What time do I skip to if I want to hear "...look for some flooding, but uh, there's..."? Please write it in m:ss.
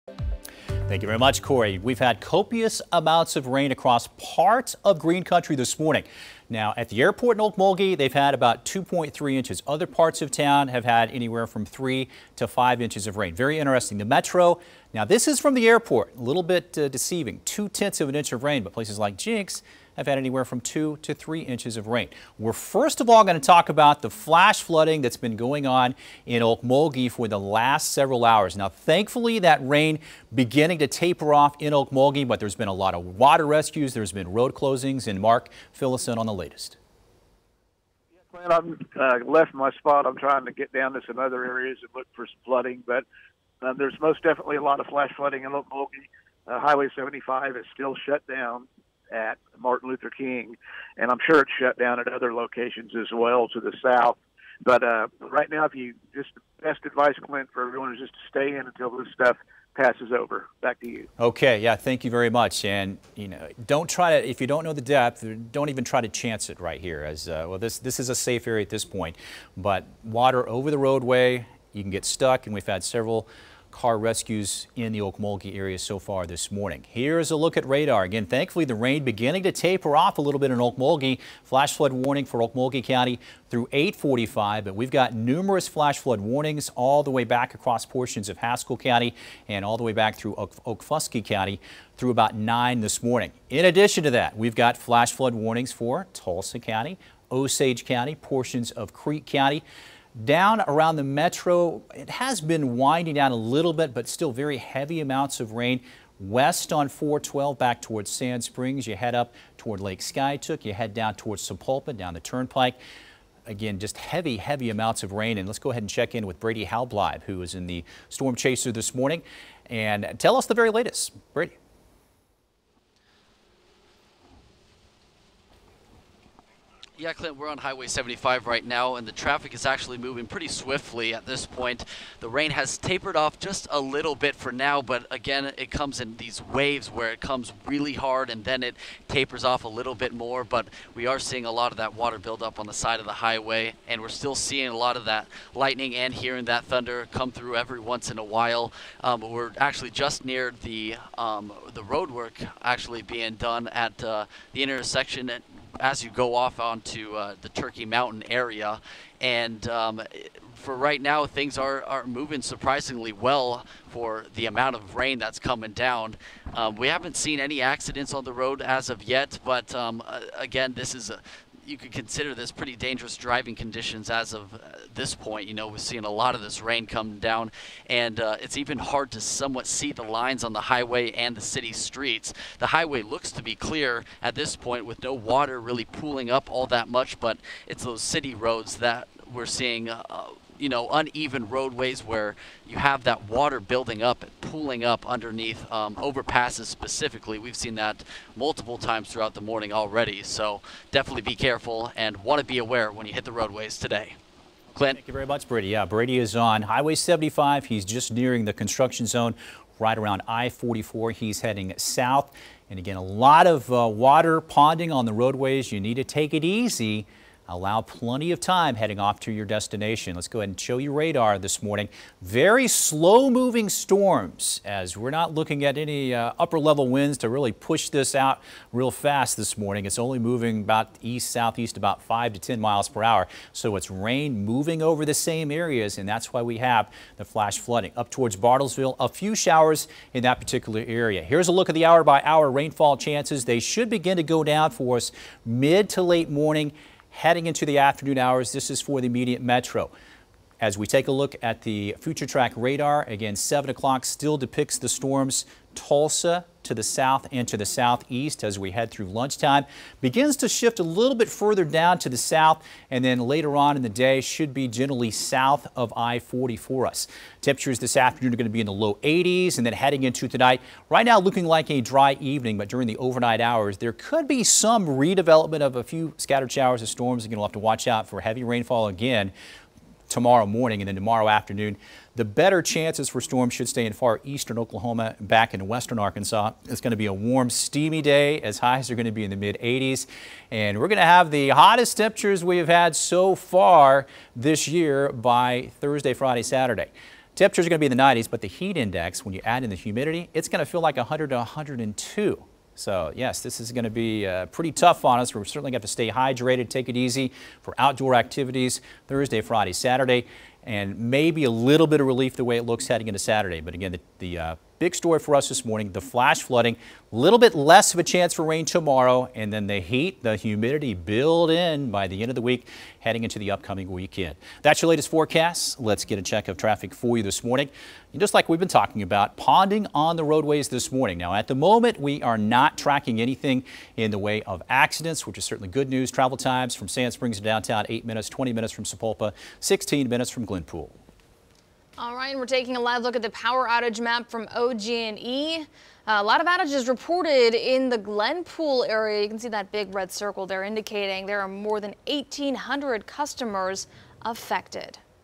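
0:41.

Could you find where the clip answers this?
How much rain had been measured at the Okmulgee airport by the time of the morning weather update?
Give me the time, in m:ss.
0:08.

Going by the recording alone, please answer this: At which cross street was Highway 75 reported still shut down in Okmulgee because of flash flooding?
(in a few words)
Martin Luther King.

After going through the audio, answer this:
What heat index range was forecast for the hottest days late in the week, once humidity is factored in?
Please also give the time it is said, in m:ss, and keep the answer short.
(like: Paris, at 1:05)
100 to 102, at 5:00.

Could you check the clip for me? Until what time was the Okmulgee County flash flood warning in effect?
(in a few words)
845.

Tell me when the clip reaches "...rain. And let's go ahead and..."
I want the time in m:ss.
1:55.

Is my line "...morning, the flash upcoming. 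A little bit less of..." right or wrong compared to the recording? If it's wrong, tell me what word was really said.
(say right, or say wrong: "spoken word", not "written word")
wrong: "flooding", not "upcoming".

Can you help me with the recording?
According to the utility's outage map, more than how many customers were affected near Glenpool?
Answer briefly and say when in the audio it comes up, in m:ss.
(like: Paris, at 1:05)
1,800, at 5:52.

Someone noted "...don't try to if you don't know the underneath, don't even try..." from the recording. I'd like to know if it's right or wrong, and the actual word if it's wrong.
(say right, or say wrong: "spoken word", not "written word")
wrong: "depth", not "underneath".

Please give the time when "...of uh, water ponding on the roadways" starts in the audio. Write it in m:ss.
3:33.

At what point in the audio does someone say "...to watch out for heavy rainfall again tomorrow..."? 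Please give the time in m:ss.
4:37.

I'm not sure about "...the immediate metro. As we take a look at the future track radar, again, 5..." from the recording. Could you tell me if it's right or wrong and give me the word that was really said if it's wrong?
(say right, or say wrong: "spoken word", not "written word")
wrong: "7", not "5".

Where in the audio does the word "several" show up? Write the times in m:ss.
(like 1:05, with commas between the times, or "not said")
0:27, 1:12.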